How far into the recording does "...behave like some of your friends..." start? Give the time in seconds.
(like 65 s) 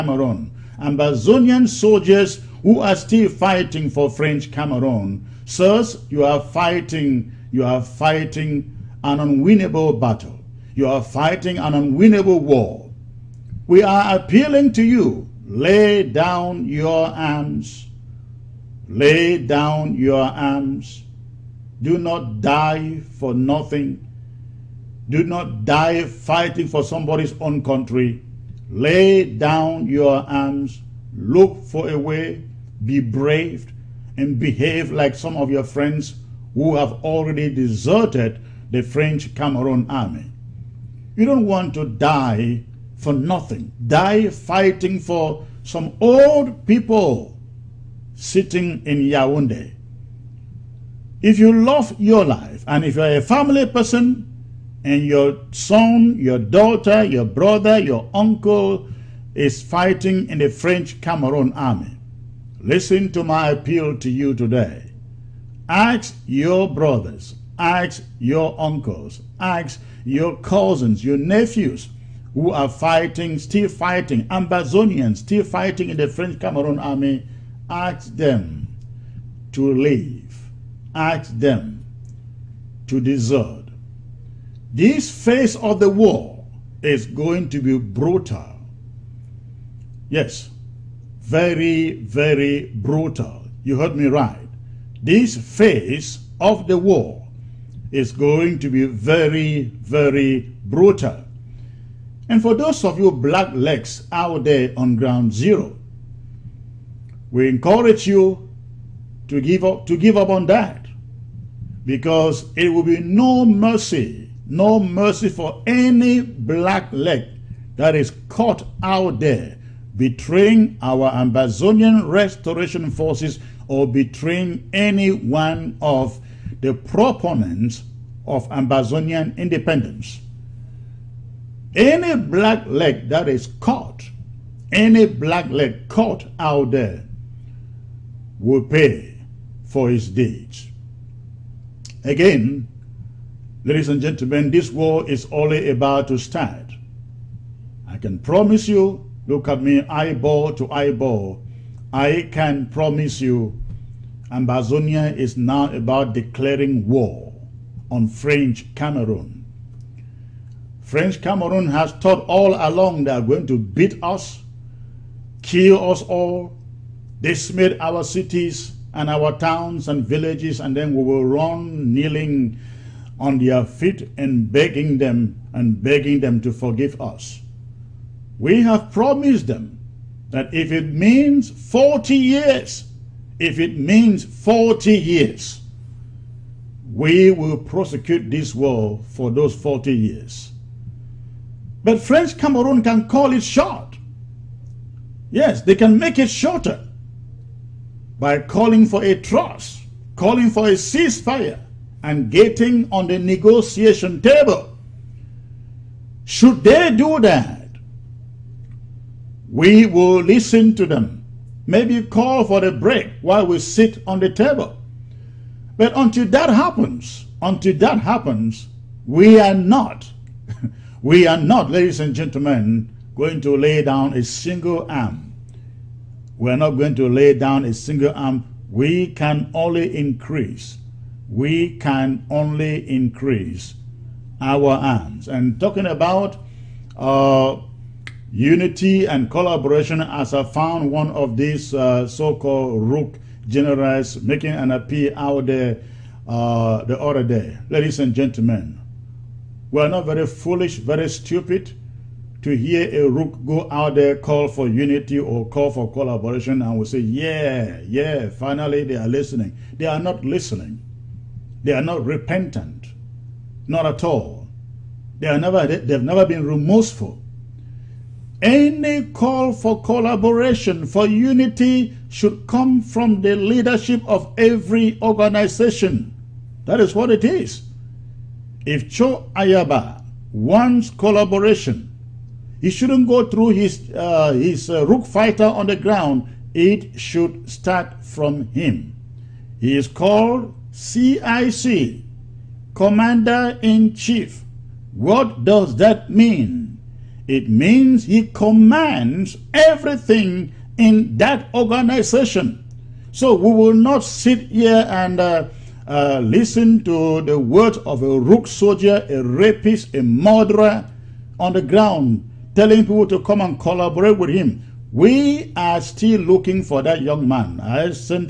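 34 s.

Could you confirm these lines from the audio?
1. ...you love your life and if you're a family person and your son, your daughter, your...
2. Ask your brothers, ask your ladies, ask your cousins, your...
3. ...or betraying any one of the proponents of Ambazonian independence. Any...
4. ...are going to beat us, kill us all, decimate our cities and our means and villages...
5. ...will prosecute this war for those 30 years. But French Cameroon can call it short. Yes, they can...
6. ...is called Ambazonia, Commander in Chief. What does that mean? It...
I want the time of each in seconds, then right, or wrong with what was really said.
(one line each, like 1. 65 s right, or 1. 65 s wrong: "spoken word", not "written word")
1. 51 s right
2. 65 s wrong: "uncles", not "ladies"
3. 123 s right
4. 163 s wrong: "towns", not "means"
5. 187 s wrong: "40", not "30"
6. 289 s wrong: "CIC", not "Ambazonia".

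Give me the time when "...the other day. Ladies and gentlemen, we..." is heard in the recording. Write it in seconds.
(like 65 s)
246 s.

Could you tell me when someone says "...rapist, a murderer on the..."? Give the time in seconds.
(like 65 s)
309 s.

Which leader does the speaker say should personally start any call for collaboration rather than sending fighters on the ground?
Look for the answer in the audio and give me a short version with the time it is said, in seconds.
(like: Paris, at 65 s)
Cho Ayaba, at 278 s.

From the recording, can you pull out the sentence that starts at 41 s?
You don't want to die for nothing.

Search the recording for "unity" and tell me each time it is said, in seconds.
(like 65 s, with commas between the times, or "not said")
238 s, 254 s, 271 s.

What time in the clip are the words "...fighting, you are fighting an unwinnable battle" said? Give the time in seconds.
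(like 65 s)
6 s.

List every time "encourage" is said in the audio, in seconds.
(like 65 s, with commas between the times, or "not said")
107 s.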